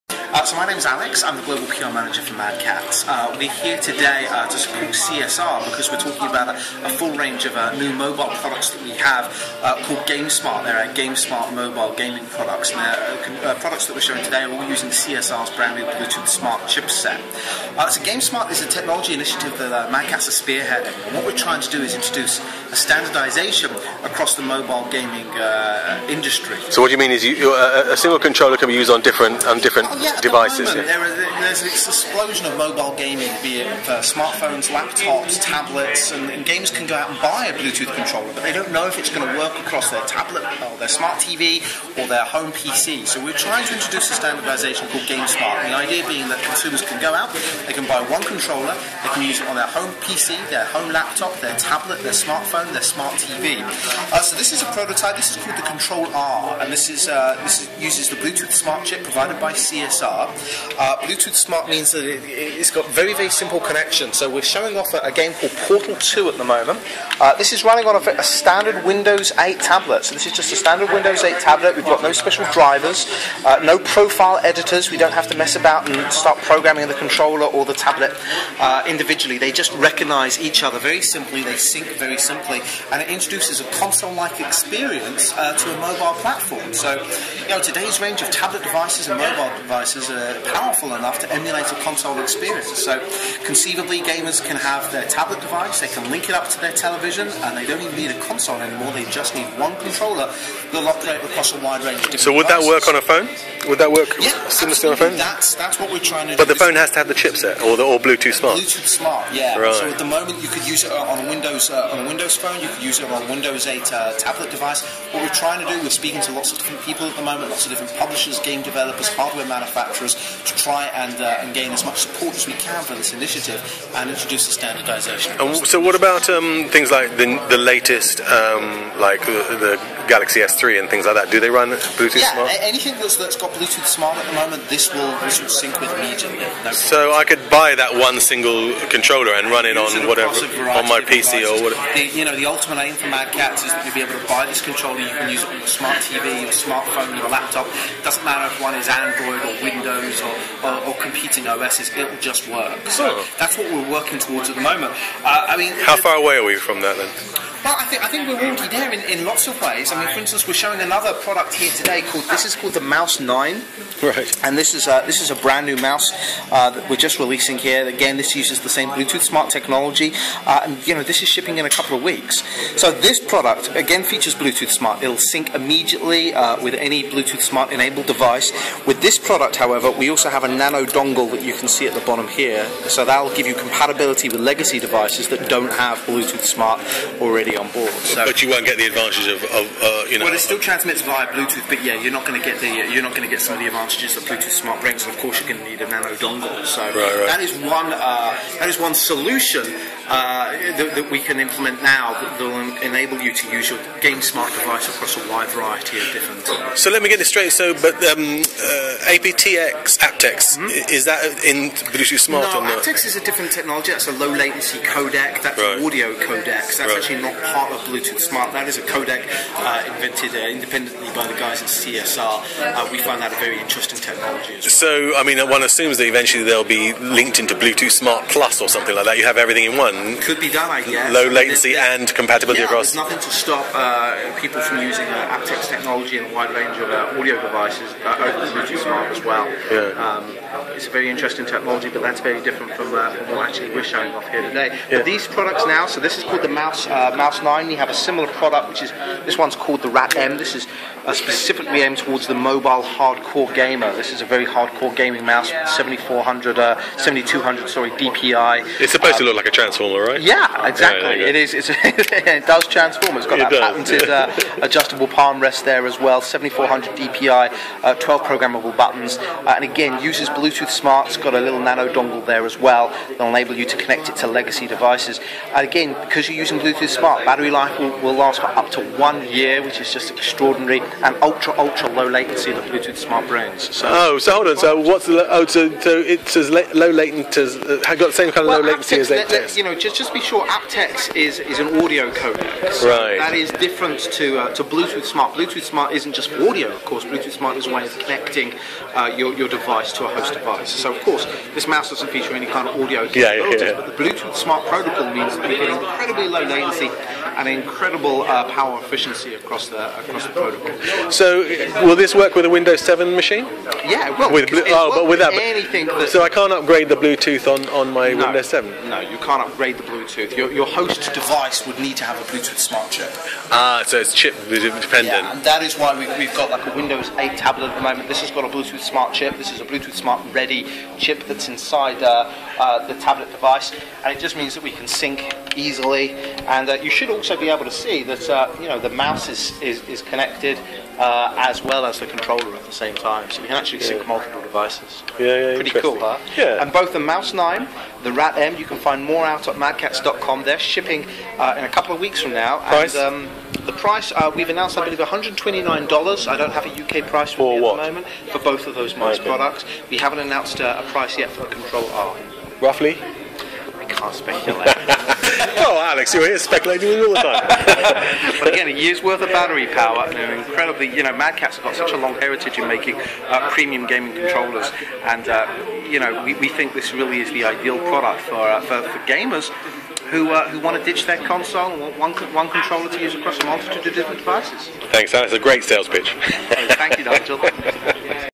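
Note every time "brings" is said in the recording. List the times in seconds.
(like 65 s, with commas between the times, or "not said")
194 s, 283 s.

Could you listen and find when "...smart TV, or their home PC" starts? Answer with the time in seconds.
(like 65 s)
40 s.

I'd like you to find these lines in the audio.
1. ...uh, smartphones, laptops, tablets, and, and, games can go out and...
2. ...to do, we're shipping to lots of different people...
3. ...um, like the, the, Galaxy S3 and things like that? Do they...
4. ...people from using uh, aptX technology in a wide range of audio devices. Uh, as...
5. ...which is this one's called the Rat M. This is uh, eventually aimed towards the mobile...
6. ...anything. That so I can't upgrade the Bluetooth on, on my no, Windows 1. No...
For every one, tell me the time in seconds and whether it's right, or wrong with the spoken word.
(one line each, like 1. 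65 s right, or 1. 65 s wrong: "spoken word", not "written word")
1. 33 s right
2. 115 s wrong: "speaking", not "shipping"
3. 128 s right
4. 234 s right
5. 248 s wrong: "specifically", not "eventually"
6. 315 s wrong: "7", not "1".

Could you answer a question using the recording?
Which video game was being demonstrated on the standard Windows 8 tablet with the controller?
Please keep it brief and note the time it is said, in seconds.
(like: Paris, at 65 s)
Portal 2, at 65 s.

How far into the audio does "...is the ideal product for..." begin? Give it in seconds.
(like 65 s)
377 s.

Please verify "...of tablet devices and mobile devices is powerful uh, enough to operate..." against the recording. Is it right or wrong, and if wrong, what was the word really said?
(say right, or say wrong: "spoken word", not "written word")
wrong: "emulate", not "operate".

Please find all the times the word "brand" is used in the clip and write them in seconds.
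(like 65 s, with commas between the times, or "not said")
15 s, 165 s.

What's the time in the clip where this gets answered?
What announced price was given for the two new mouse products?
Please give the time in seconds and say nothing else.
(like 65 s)
354 s.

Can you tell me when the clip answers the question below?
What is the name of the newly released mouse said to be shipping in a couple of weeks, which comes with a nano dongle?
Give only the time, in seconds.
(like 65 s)
162 s.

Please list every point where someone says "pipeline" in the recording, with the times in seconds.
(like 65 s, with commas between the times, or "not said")
not said.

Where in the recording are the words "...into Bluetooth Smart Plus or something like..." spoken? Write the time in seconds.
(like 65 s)
227 s.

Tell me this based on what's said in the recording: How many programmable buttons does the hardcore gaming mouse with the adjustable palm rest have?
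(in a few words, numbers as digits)
12.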